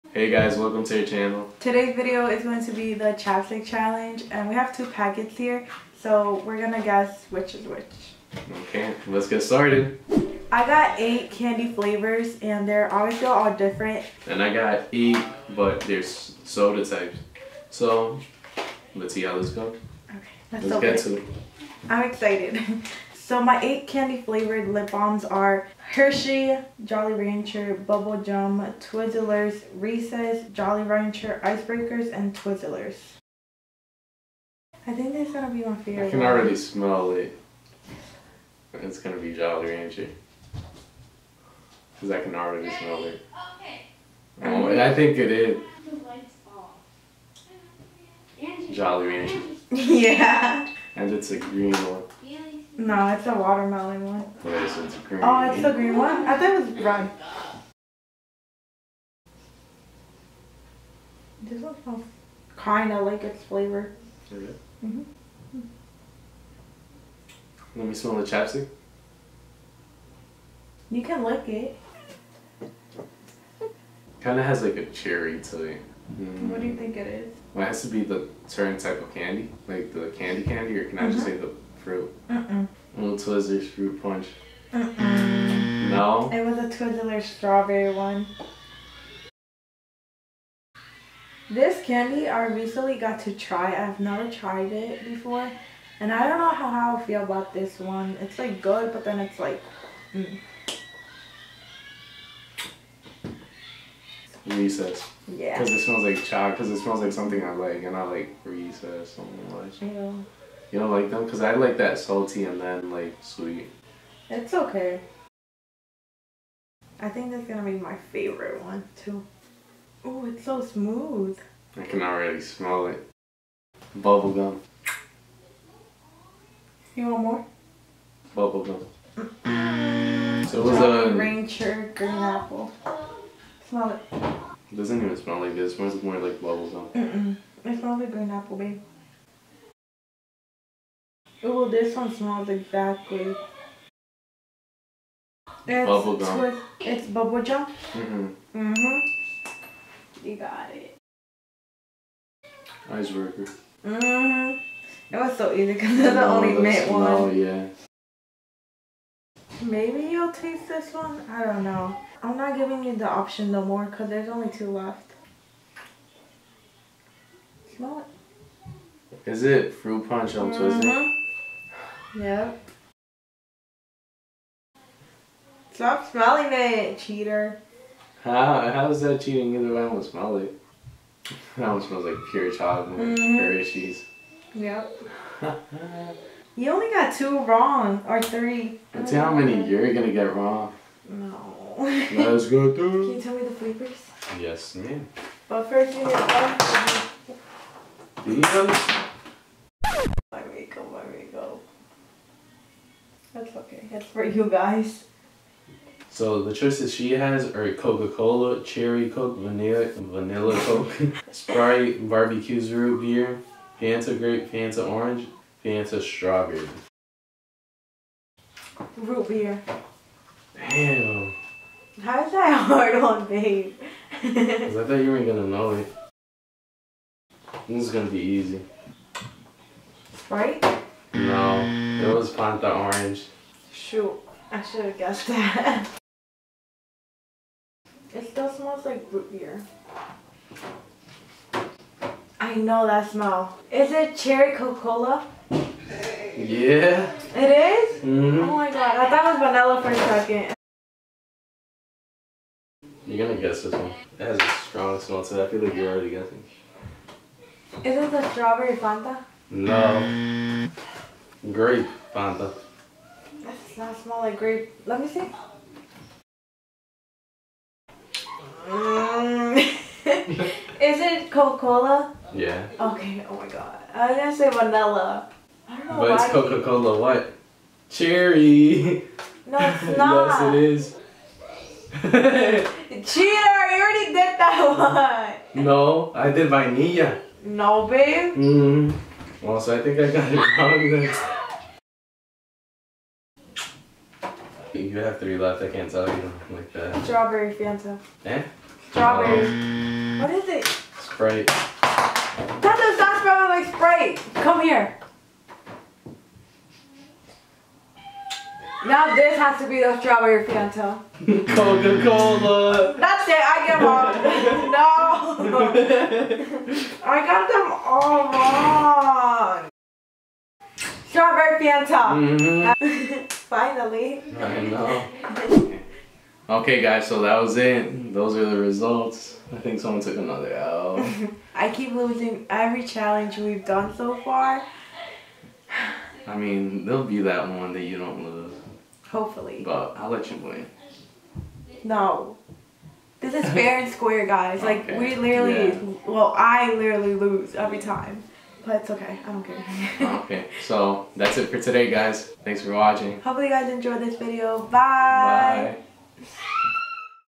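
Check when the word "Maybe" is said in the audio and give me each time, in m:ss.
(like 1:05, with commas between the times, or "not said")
2:39.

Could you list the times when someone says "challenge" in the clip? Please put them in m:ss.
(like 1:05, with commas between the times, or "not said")
0:03, 5:32.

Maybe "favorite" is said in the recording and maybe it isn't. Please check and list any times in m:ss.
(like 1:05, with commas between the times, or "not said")
0:35, 1:58.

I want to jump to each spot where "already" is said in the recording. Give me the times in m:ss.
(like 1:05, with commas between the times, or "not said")
0:36, 0:42, 2:02, 4:15, 4:43.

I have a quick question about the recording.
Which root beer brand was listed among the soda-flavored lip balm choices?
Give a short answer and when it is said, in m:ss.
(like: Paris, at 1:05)
Barq's, at 3:32.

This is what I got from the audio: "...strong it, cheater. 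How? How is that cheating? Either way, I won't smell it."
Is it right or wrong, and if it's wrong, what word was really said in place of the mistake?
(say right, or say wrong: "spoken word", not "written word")
wrong: "smelling", not "strong".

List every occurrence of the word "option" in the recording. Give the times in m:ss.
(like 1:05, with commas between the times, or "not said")
2:43.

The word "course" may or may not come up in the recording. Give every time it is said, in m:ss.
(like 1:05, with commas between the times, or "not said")
not said.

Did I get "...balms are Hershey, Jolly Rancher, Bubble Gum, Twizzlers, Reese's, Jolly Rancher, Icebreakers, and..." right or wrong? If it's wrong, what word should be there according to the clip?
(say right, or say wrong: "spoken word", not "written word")
right.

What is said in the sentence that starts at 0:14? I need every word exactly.
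And I got eight, but they're soda types.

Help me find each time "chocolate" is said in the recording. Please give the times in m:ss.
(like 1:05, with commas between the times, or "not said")
1:46, 3:02.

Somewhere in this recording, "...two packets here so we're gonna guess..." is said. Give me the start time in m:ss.
0:04.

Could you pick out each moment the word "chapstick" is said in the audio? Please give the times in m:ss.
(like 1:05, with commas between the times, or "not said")
0:03, 1:08.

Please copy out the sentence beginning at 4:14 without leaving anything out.
It has a strong smell to it.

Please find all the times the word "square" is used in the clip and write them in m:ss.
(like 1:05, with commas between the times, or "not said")
5:43.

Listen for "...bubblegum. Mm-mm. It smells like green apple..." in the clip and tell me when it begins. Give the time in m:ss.
2:16.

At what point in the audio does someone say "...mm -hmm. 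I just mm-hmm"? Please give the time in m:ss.
1:20.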